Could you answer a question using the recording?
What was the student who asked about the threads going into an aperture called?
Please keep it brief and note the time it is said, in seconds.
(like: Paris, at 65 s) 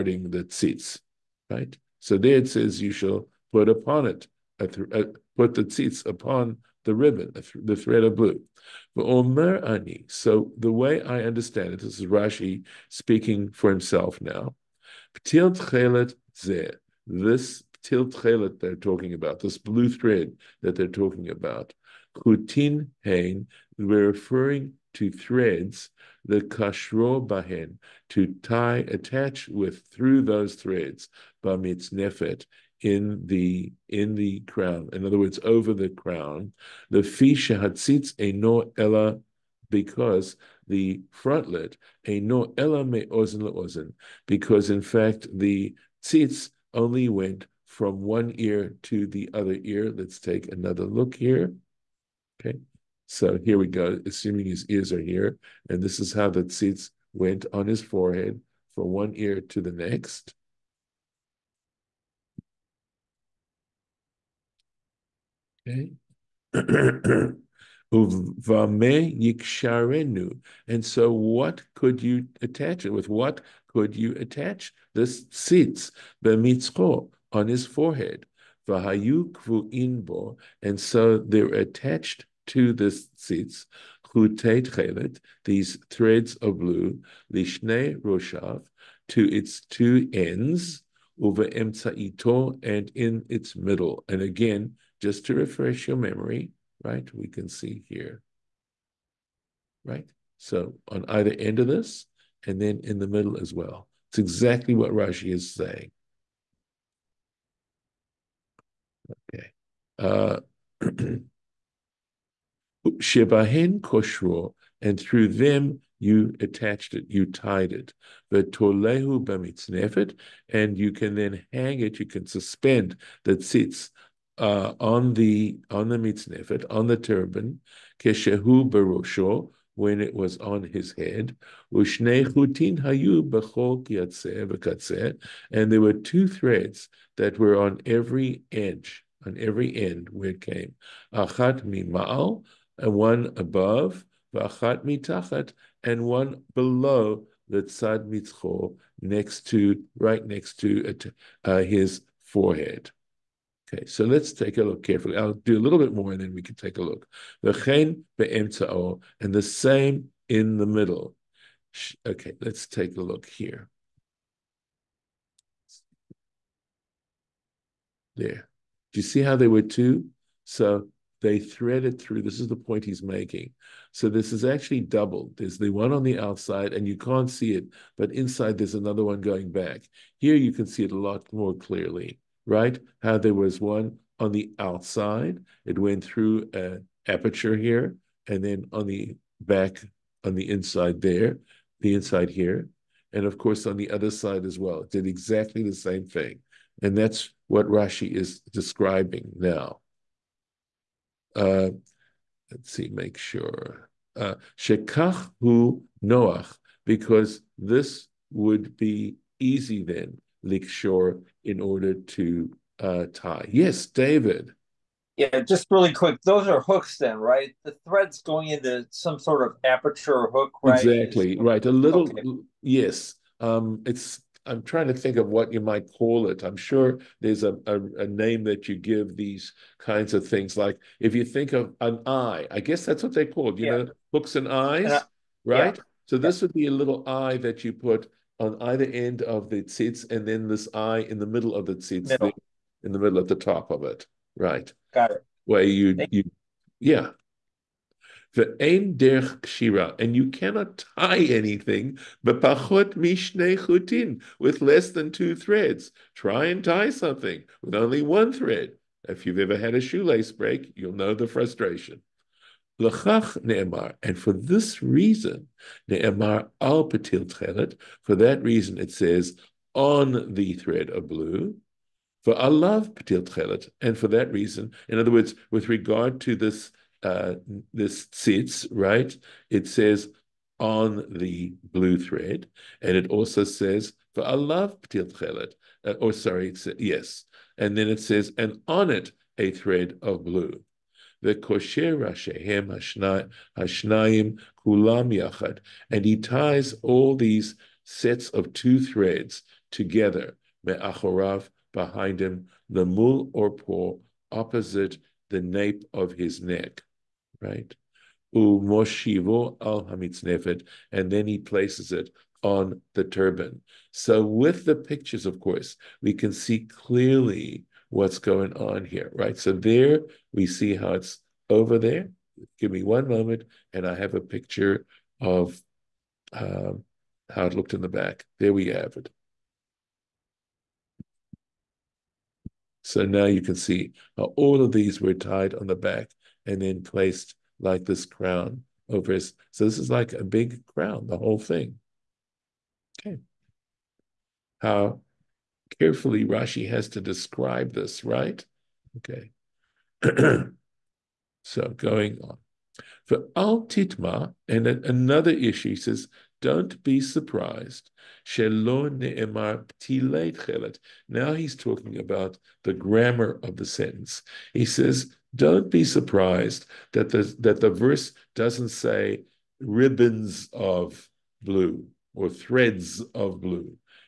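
David, at 213 s.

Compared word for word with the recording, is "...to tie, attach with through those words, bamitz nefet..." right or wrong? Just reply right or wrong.
wrong.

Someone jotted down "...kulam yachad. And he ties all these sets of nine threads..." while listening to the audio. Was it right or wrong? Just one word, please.
wrong.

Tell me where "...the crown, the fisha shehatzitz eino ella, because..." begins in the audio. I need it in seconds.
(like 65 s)
35 s.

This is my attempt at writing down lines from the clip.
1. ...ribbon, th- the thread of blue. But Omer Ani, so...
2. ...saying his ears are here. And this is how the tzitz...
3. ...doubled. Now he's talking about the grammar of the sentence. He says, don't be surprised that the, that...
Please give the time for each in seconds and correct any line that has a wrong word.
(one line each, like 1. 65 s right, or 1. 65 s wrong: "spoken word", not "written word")
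1. 6 s right
2. 54 s wrong: "assuming", not "saying"
3. 357 s wrong: "surprised", not "doubled".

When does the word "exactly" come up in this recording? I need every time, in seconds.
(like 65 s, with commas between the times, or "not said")
104 s, 195 s, 220 s.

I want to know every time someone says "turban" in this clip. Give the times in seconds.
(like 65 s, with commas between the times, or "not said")
126 s, 313 s.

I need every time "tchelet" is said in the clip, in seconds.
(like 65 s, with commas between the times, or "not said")
267 s, 273 s, 285 s.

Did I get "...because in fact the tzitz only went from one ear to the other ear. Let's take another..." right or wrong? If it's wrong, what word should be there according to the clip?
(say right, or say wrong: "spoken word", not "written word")
right.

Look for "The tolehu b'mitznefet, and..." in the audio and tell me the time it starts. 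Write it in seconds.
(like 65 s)
118 s.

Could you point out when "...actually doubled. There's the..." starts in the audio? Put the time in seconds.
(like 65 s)
174 s.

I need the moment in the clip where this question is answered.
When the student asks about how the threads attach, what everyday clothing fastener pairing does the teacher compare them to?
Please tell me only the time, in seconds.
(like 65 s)
234 s.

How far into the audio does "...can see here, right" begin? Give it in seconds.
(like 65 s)
97 s.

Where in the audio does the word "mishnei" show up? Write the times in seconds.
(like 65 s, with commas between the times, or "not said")
252 s.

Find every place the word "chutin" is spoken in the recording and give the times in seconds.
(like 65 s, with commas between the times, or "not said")
22 s, 253 s.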